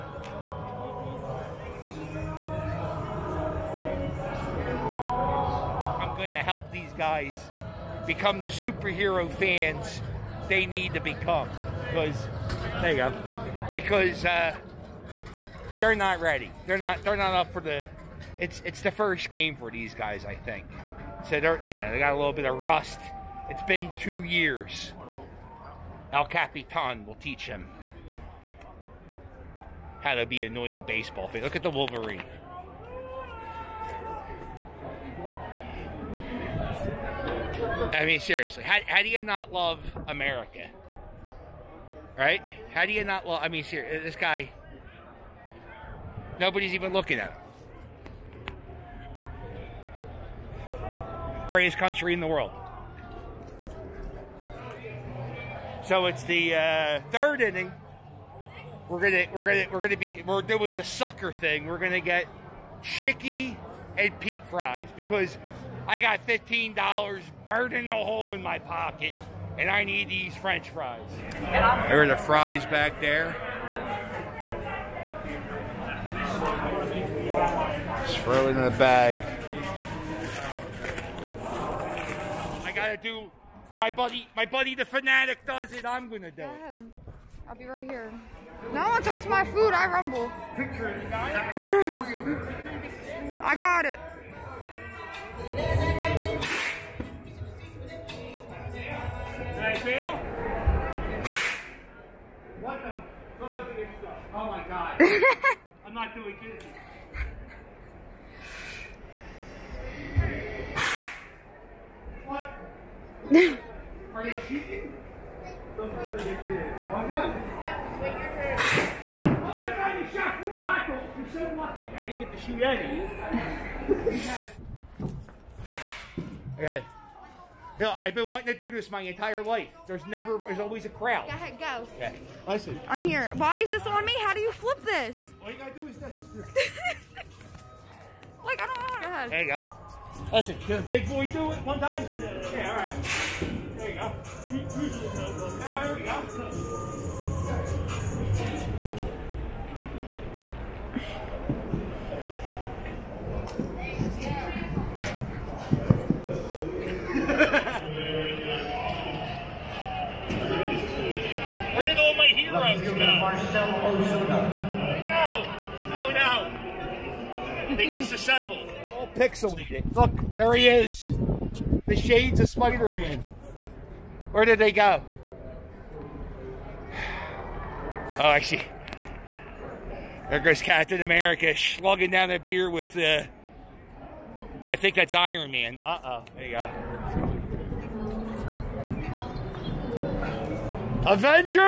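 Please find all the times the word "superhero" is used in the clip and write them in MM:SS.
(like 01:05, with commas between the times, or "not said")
00:08.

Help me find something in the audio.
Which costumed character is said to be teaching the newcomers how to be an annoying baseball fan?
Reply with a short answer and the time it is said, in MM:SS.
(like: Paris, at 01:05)
El Capitan, at 00:26.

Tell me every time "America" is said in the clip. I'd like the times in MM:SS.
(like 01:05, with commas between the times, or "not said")
00:40, 03:01.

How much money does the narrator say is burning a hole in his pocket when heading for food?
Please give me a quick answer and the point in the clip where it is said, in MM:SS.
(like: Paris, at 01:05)
$15, at 01:06.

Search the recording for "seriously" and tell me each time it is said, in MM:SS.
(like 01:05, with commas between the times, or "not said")
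00:38, 00:43.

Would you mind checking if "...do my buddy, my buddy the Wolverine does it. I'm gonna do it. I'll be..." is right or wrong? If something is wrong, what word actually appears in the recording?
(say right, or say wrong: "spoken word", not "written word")
wrong: "Phanatic", not "Wolverine".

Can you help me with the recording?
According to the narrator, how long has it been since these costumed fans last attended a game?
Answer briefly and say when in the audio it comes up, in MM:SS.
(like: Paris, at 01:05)
2 years, at 00:23.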